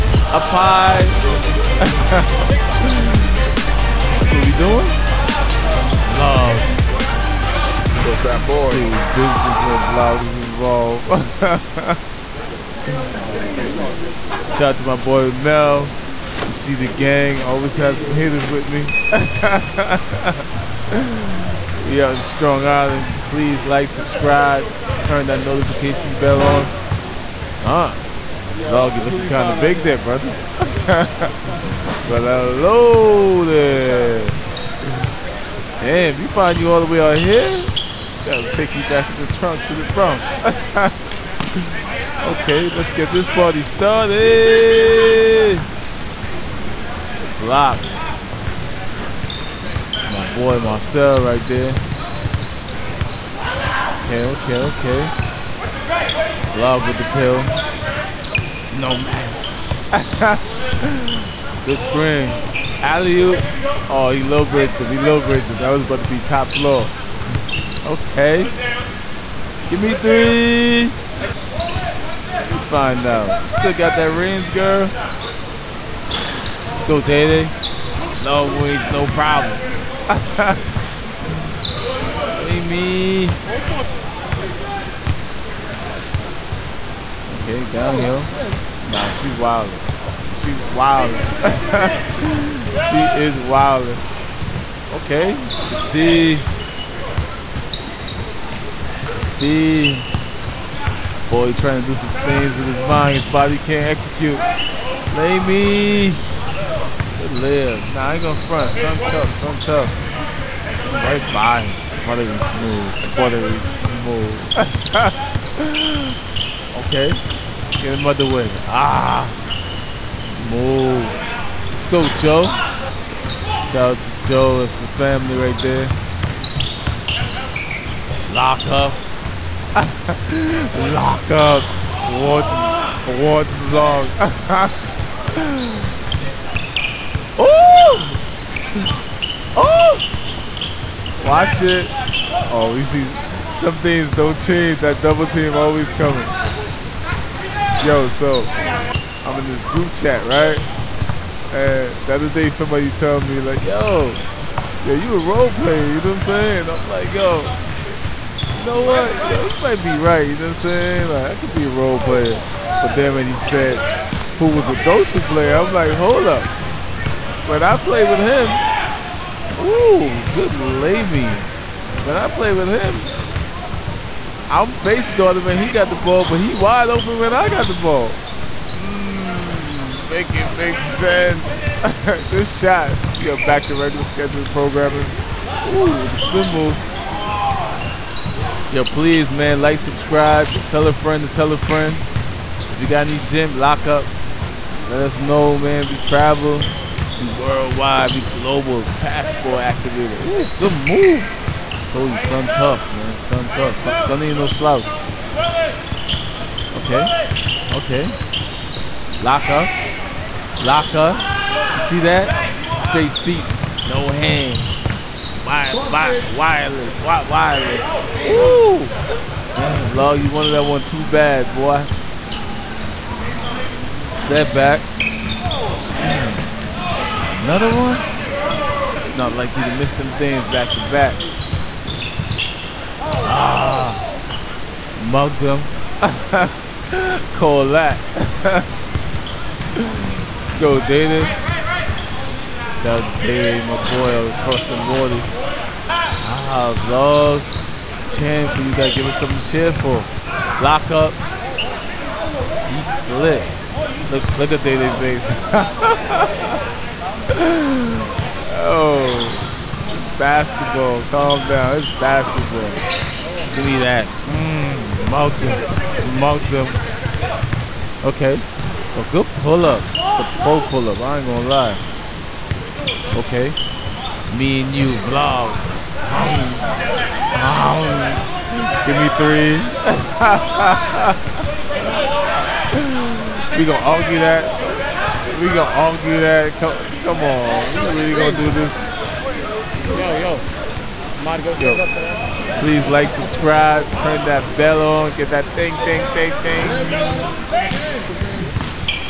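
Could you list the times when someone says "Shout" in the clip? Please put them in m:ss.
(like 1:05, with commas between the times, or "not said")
0:14, 2:03, 4:02.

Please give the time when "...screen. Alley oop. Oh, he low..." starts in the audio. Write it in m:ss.
1:01.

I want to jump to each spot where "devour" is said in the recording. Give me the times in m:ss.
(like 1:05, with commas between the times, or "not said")
not said.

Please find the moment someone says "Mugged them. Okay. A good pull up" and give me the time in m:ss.
4:26.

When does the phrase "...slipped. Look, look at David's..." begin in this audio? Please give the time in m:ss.
4:12.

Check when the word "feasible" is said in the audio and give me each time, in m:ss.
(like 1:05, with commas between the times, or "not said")
not said.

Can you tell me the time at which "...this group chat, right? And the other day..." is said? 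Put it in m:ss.
2:29.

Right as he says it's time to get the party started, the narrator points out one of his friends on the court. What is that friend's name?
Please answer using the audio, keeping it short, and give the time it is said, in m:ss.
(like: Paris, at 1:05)
Marcel, at 0:50.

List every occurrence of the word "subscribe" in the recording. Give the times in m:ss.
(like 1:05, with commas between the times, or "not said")
0:23, 3:09, 4:53.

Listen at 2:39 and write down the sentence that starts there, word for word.
Yo, you might be right, you know what I'm saying?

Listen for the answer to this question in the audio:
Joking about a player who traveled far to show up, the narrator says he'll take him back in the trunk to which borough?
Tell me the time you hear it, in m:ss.
0:39.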